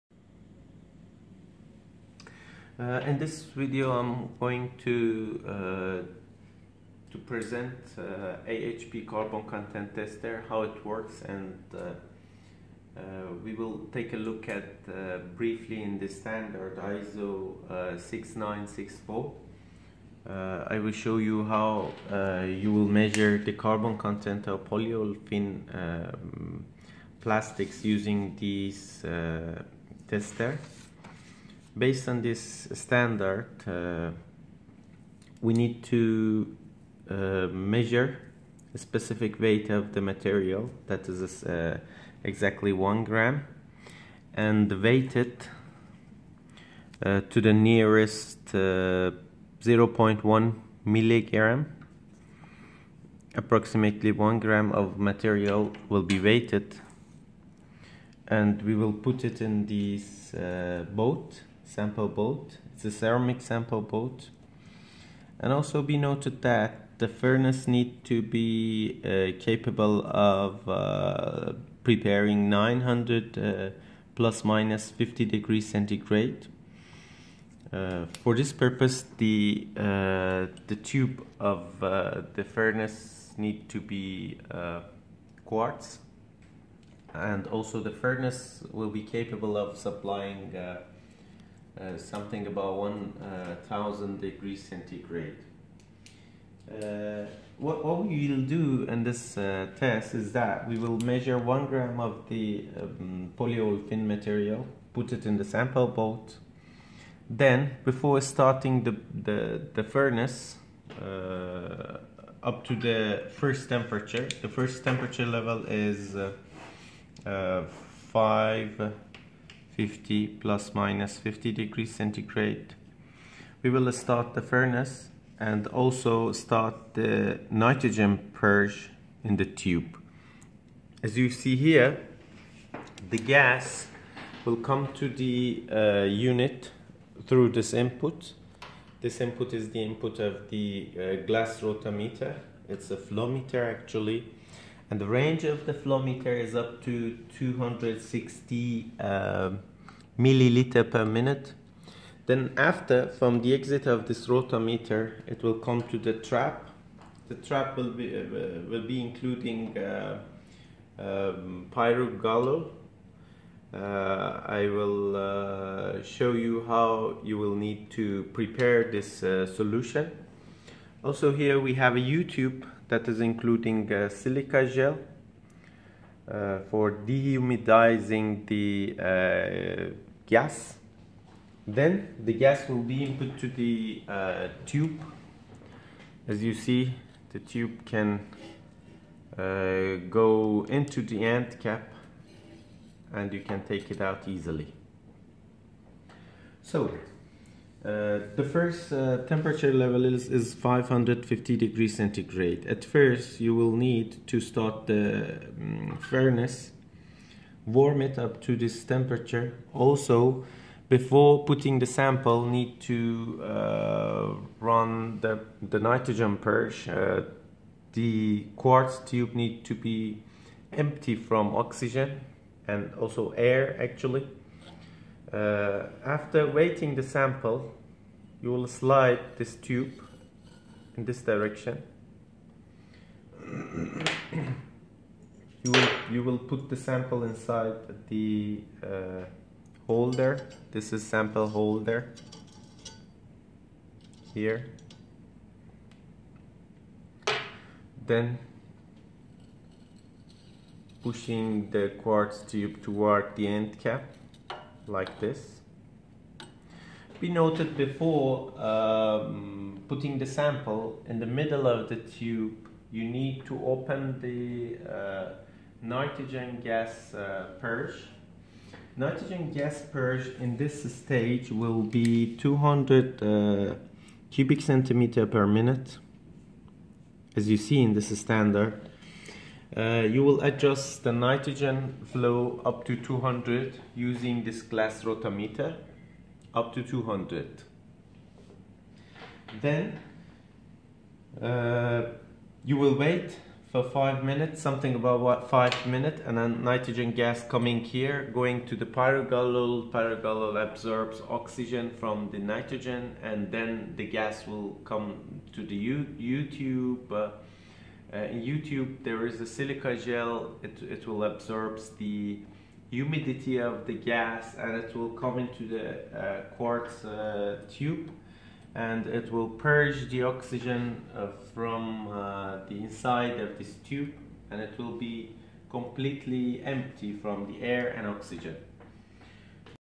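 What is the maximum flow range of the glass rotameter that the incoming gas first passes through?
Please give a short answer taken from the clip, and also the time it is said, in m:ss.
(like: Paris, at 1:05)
260 milliliters per minute, at 2:27.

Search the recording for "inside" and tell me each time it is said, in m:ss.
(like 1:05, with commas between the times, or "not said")
3:57, 5:22.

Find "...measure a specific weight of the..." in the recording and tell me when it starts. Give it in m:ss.
0:37.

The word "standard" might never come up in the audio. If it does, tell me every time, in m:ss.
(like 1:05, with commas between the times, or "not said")
0:16, 0:32, 4:38.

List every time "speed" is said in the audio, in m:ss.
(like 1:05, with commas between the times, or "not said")
not said.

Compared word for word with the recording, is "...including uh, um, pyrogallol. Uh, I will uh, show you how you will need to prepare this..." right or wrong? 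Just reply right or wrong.
right.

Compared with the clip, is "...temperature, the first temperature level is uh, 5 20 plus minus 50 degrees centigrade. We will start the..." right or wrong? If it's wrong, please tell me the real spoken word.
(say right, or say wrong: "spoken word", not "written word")
wrong: "50", not "20".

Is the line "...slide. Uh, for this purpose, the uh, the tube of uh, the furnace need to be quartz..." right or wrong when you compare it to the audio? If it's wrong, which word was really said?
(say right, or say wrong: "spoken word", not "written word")
wrong: "centigrade", not "slide".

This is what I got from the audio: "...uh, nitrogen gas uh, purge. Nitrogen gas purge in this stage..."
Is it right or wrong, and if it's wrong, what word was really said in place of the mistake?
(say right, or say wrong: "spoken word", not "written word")
right.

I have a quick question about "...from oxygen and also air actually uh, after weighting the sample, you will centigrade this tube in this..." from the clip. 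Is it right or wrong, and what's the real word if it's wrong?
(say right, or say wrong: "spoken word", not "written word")
wrong: "slide", not "centigrade".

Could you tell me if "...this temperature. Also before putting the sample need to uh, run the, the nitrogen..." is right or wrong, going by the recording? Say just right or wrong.
right.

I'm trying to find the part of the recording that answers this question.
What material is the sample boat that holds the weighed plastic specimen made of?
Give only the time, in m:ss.
1:02.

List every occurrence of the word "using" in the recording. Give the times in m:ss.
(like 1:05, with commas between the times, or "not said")
0:27, 4:43.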